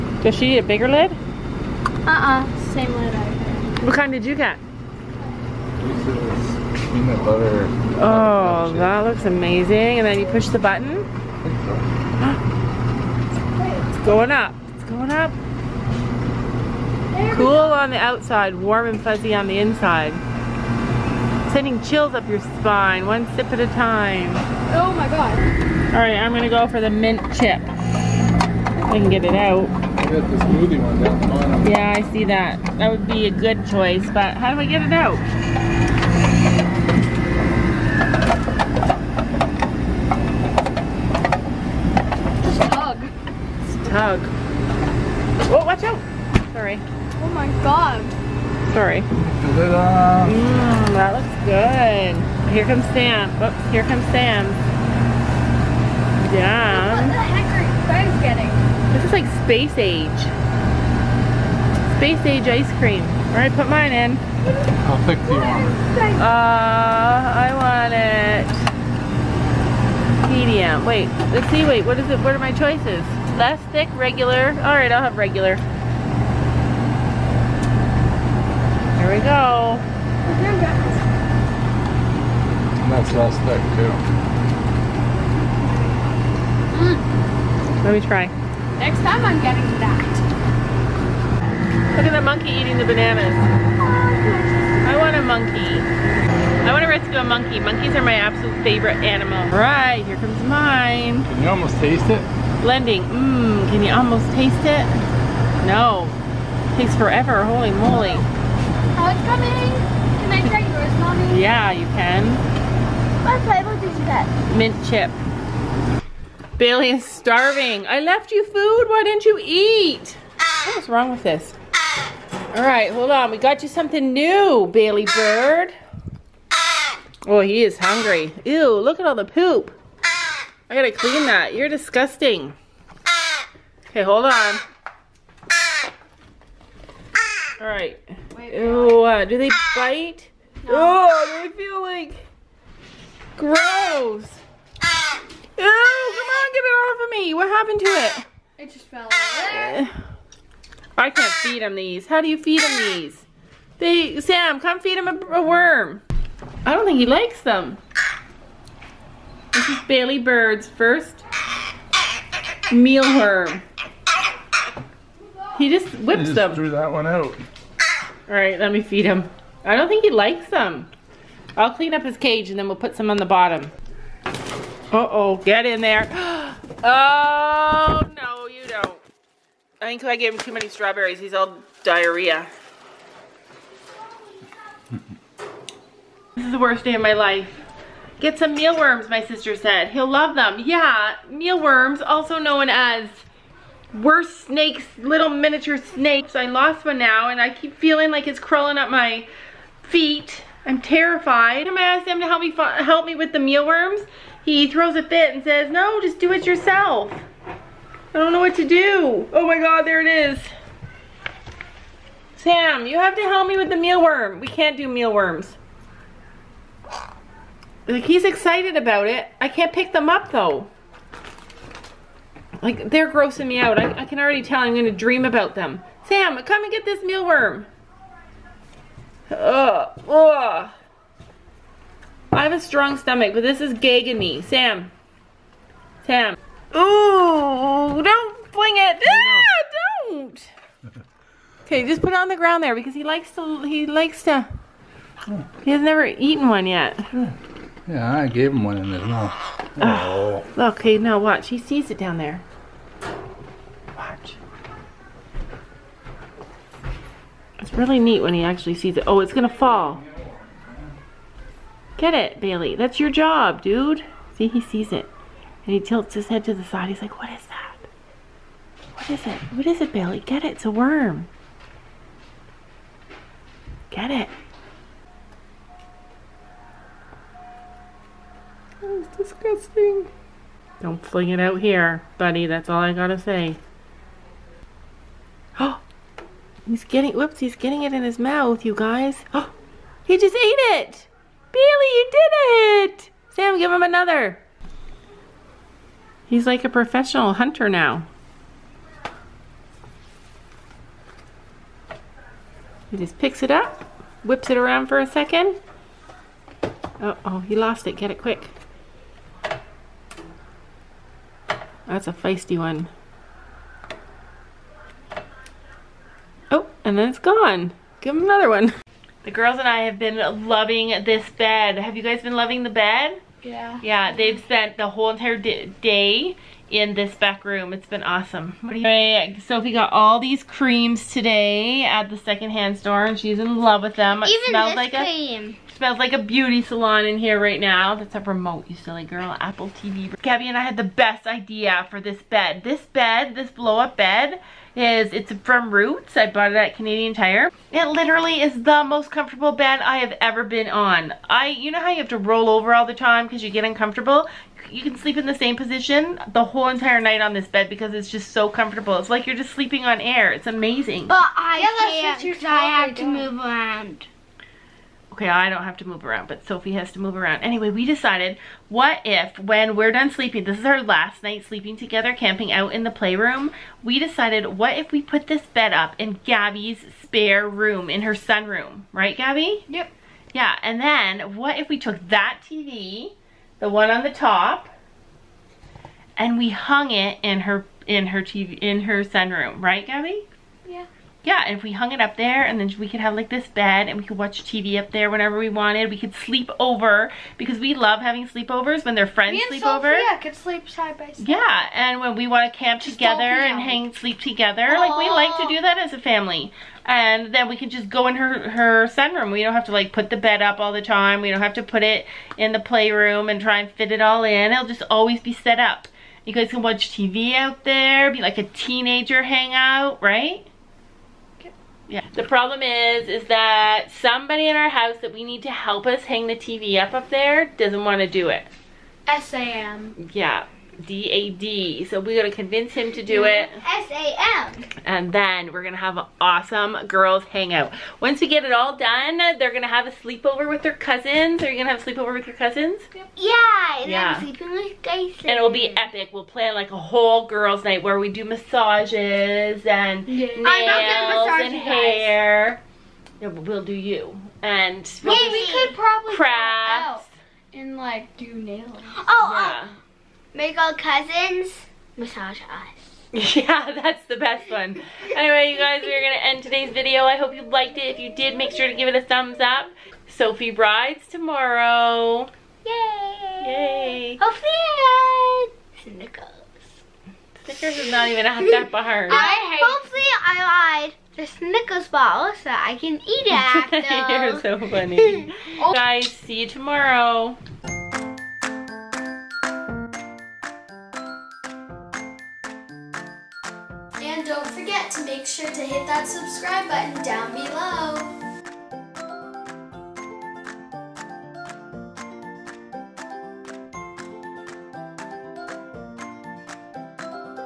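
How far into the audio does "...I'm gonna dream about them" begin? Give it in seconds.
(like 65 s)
224 s.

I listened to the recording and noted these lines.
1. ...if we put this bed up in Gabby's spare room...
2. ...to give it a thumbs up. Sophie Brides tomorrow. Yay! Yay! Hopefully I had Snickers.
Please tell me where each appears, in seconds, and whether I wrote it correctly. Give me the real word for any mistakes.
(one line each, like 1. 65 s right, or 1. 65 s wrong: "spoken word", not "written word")
1. 374 s right
2. 468 s right.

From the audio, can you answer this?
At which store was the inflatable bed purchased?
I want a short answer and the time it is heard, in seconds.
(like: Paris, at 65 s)
Canadian Tire, at 346 s.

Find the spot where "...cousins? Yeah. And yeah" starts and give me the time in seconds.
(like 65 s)
442 s.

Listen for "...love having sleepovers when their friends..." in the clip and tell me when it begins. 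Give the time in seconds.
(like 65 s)
397 s.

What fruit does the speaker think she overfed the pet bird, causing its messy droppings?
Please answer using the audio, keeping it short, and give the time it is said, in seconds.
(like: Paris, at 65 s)
Strawberries, at 180 s.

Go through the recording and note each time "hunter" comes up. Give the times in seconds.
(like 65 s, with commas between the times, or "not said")
297 s.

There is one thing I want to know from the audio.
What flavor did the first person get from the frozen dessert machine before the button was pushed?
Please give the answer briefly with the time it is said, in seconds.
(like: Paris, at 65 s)
Peanut butter, at 6 s.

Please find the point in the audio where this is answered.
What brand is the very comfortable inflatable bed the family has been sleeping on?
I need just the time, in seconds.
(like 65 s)
345 s.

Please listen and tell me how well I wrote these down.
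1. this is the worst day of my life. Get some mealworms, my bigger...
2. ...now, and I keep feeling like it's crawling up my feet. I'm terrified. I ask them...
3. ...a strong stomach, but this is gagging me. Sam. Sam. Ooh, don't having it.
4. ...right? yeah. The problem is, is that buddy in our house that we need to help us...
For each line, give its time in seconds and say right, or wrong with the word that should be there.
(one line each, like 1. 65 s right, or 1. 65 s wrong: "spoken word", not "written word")
1. 186 s wrong: "sister", not "bigger"
2. 196 s right
3. 232 s wrong: "fling", not "having"
4. 420 s wrong: "somebody", not "buddy".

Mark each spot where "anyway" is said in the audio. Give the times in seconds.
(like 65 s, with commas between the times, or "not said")
367 s, 465 s.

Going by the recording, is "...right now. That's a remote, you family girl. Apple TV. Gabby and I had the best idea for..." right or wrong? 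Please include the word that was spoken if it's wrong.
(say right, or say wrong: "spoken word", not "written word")
wrong: "silly", not "family".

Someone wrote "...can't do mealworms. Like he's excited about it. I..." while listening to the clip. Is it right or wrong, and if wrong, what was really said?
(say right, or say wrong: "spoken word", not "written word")
right.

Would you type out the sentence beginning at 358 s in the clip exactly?
It's like you're just sleeping on air.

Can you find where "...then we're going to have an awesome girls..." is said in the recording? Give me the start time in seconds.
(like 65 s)
435 s.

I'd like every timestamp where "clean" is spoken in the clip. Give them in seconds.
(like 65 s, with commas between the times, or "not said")
130 s, 171 s.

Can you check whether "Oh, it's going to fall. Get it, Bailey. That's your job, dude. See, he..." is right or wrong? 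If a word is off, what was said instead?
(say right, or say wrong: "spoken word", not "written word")
right.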